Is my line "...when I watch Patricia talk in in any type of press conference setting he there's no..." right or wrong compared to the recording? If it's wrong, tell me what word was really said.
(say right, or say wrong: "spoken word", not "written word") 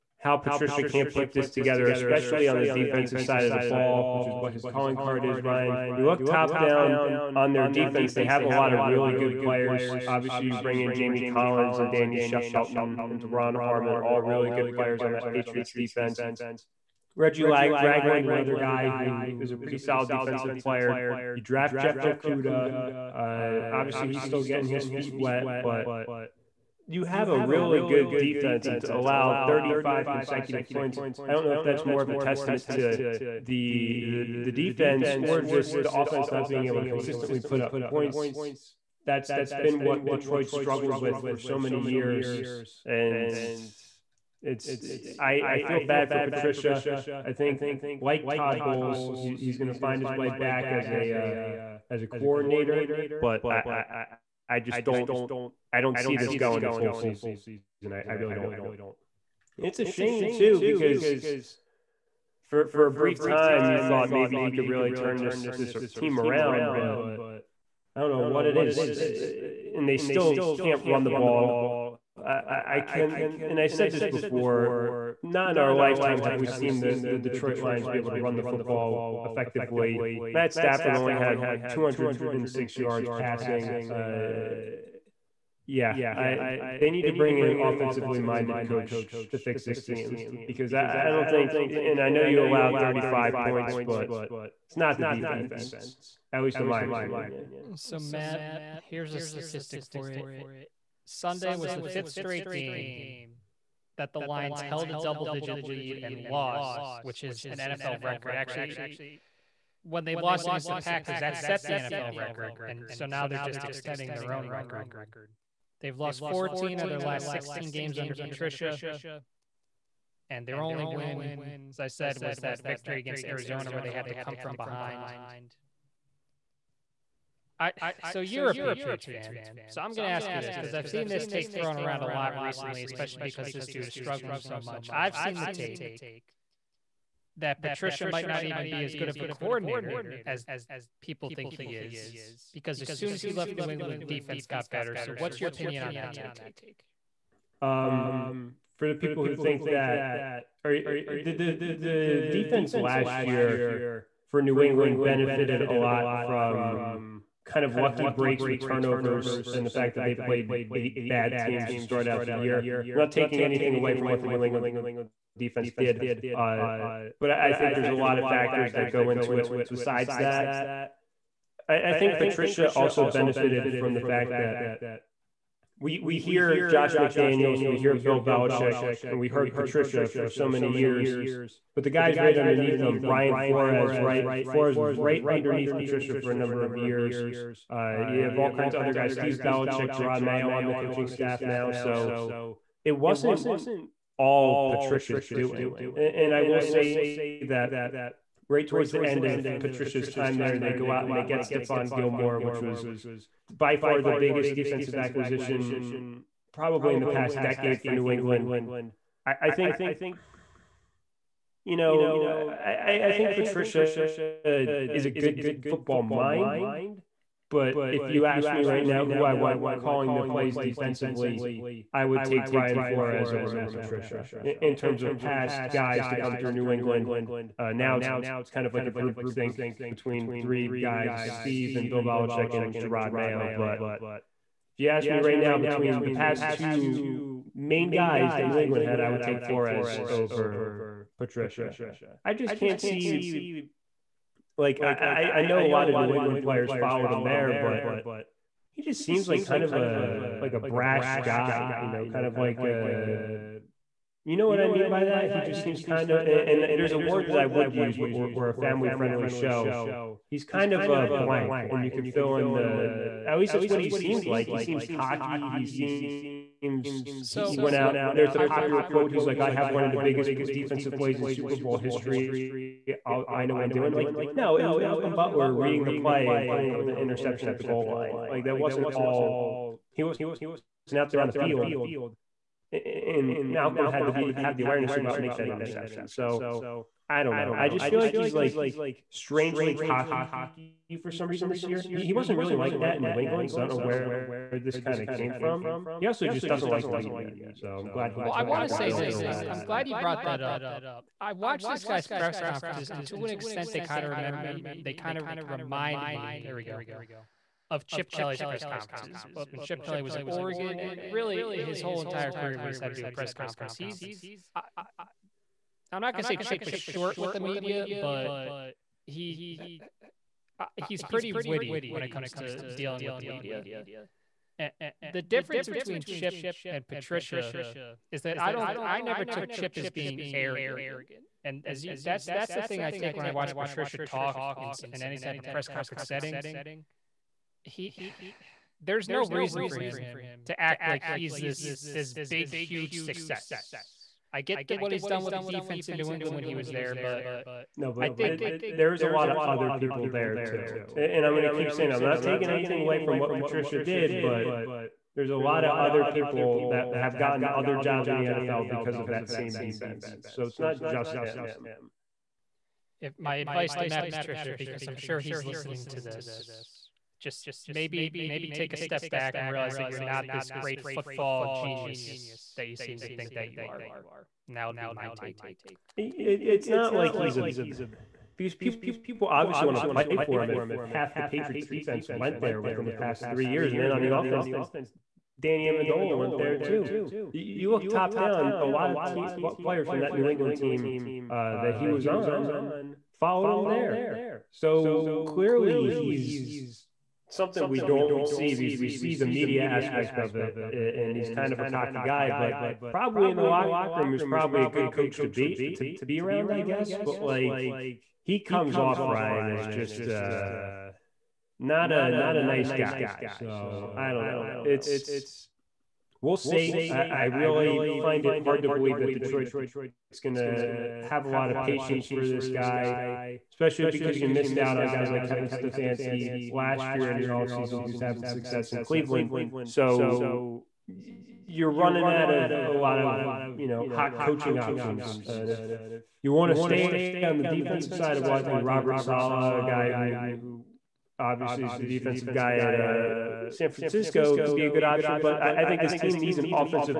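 right.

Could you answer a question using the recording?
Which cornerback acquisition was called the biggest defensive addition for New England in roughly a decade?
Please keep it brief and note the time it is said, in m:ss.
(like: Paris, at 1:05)
Stephon Gilmore, at 3:21.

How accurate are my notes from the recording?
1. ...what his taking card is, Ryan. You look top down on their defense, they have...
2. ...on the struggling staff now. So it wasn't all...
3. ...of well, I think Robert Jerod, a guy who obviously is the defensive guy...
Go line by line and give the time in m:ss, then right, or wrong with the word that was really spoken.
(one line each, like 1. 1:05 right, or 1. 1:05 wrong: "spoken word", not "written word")
1. 0:04 wrong: "calling", not "taking"
2. 3:10 wrong: "coaching", not "struggling"
3. 7:18 wrong: "Saleh", not "Jerod".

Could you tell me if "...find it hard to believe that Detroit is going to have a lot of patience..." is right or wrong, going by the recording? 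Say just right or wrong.
right.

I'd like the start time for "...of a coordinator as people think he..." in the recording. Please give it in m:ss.
2:19.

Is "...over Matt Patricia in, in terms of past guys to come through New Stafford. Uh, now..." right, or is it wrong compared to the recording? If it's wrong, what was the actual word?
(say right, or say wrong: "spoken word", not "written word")
wrong: "England", not "Stafford".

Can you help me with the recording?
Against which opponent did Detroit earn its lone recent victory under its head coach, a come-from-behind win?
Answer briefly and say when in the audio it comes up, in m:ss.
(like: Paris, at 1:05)
Arizona, at 2:03.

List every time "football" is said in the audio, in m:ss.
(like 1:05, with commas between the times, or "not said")
1:18, 3:35, 6:10.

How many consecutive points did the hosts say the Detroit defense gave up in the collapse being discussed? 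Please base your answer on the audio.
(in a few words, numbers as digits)
35.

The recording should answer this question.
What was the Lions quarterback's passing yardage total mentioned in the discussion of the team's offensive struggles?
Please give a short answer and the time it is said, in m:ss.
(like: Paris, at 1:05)
206, at 1:21.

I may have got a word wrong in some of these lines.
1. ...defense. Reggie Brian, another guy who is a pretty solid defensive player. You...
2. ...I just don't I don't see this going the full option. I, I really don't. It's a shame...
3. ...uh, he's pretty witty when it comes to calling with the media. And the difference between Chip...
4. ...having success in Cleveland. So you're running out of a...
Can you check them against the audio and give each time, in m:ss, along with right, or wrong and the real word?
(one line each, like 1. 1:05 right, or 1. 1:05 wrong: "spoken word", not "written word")
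1. 0:15 wrong: "Ragland", not "Brian"
2. 0:54 wrong: "season", not "option"
3. 5:20 wrong: "dealing", not "calling"
4. 7:07 right.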